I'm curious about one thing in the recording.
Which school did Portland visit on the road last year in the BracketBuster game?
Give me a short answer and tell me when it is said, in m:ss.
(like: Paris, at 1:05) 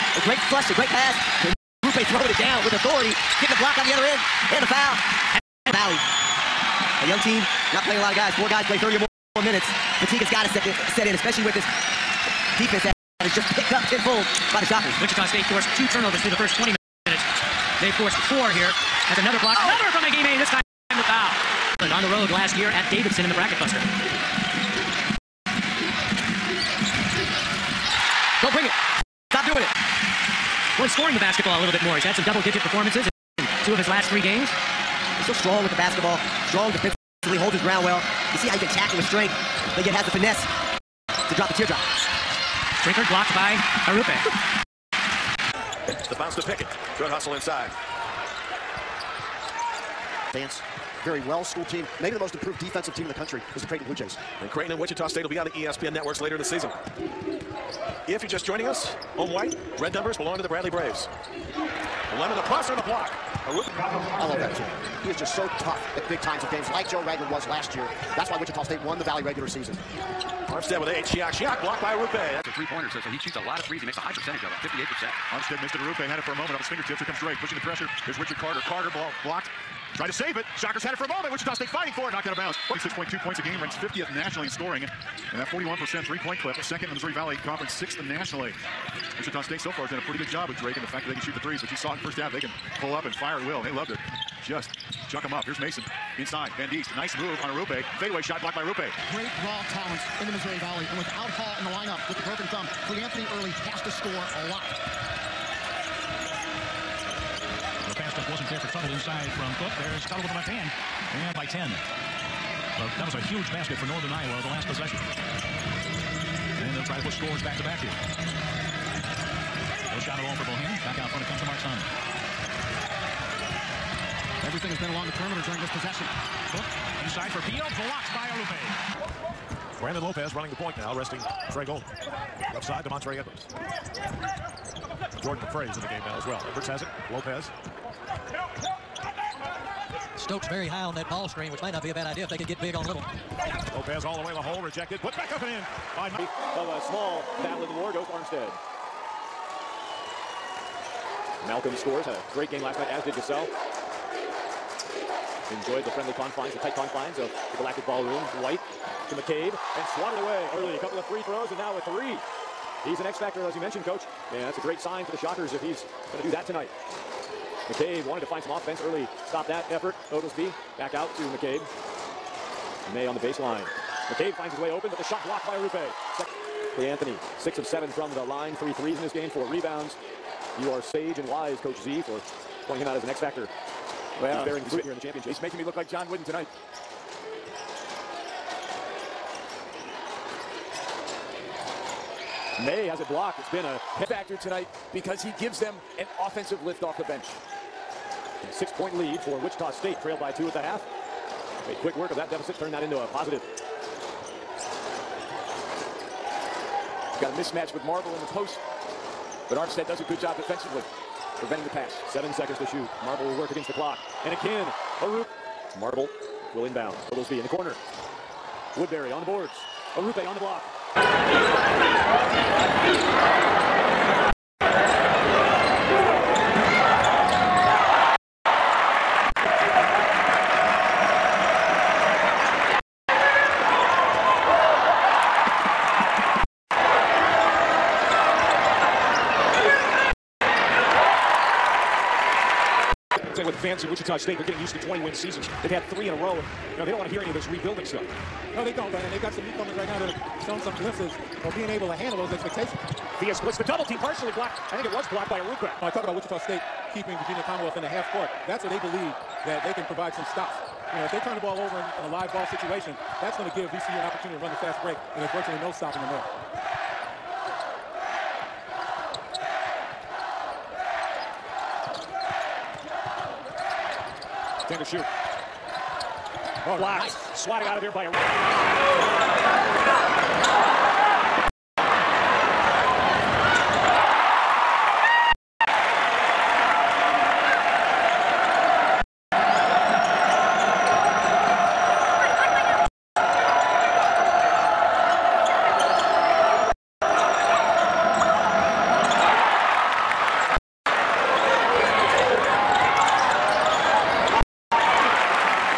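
Davidson, at 0:22.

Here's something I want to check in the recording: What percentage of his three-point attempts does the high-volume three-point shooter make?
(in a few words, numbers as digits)
58%.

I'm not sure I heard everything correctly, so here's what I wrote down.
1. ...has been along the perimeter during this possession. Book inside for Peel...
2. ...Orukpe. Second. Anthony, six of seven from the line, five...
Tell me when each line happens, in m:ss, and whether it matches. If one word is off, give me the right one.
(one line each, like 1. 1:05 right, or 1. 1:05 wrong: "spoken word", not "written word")
1. 2:04 right
2. 2:55 wrong: "three", not "five".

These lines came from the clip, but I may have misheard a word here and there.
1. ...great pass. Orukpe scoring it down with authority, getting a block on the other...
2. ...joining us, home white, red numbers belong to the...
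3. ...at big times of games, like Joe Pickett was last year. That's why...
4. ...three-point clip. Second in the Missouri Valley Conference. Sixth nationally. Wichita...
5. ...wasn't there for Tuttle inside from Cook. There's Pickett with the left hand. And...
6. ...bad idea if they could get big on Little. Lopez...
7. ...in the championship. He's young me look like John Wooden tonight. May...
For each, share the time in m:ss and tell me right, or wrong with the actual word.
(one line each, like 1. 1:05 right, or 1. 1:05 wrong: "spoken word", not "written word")
1. 0:00 wrong: "throwing", not "scoring"
2. 0:58 right
3. 1:05 wrong: "Ragland", not "Pickett"
4. 1:26 right
5. 1:48 wrong: "Tuttle", not "Pickett"
6. 2:21 right
7. 3:04 wrong: "making", not "young".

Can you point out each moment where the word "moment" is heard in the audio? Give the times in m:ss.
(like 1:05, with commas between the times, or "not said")
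1:16, 1:21.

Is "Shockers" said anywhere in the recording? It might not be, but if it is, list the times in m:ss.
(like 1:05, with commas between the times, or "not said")
0:14, 1:20, 2:45.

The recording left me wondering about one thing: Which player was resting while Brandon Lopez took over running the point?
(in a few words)
Trey Gold.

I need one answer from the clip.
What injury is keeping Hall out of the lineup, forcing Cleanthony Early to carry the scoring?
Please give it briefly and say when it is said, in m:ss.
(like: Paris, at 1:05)
Broken thumb, at 1:42.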